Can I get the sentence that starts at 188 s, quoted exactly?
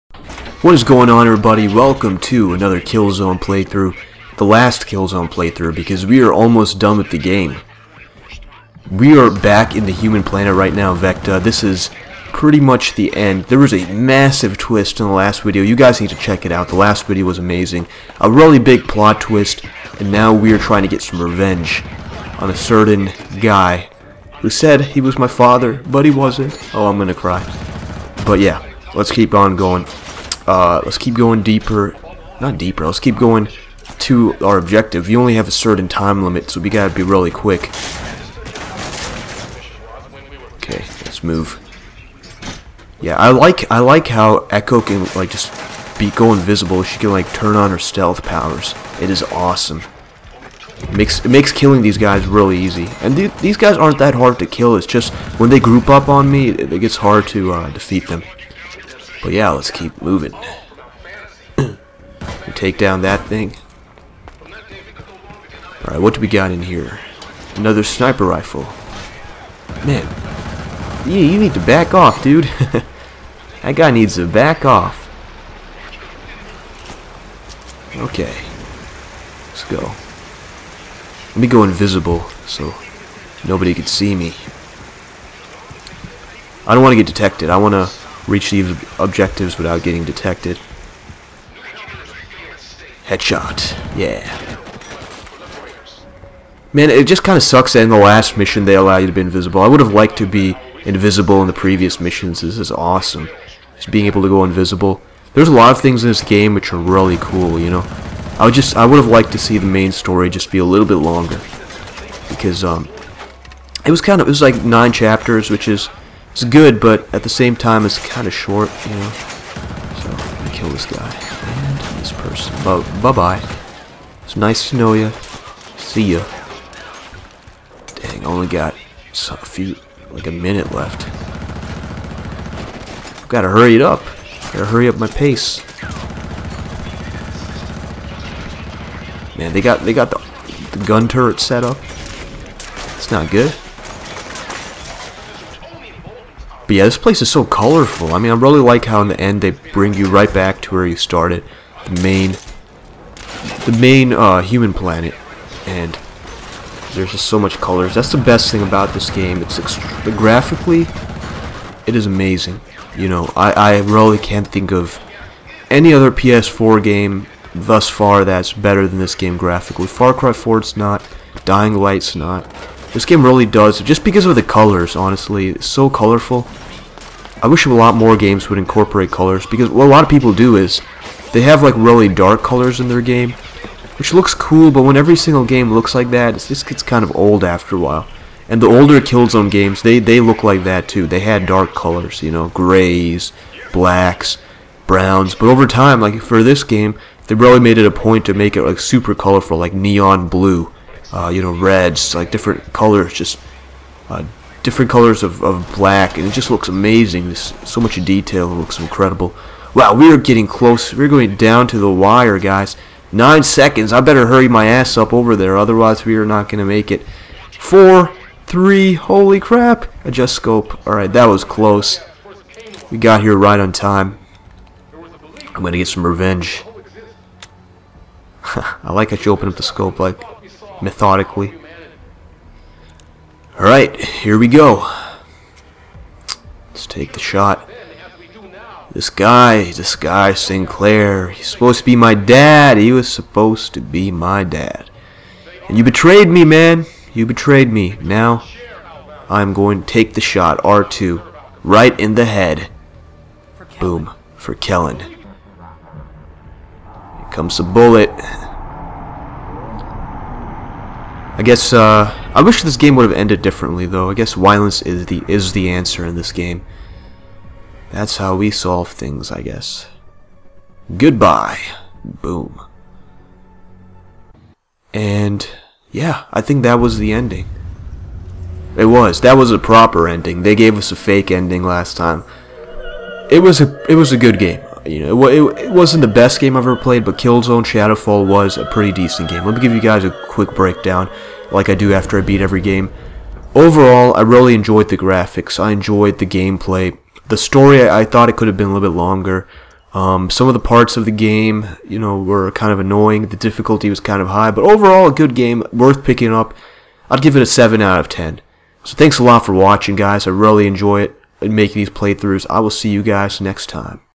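And the older Killzone games, they, they look like that too.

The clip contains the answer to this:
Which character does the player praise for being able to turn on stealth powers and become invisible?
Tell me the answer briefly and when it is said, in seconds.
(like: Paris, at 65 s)
Echo, at 44 s.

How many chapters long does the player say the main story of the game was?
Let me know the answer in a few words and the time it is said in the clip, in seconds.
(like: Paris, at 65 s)
9, at 114 s.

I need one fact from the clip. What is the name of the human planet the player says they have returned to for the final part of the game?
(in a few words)
Vekta.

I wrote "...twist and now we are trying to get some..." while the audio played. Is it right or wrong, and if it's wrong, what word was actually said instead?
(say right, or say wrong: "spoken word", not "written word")
right.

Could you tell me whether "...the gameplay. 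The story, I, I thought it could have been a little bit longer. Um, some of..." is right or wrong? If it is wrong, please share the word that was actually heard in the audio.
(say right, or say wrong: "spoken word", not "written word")
right.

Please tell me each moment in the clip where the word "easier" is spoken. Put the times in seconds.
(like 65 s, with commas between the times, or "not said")
not said.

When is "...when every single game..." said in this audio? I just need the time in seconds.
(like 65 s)
184 s.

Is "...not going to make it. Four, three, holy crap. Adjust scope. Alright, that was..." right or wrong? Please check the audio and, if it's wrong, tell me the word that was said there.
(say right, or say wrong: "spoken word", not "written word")
right.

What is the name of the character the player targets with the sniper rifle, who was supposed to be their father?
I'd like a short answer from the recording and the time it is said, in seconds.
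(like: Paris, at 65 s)
Sinclair, at 240 s.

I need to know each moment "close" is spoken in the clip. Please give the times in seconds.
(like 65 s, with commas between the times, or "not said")
210 s, 221 s.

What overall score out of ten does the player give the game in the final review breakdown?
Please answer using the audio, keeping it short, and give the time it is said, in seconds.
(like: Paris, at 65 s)
7 out of 10, at 307 s.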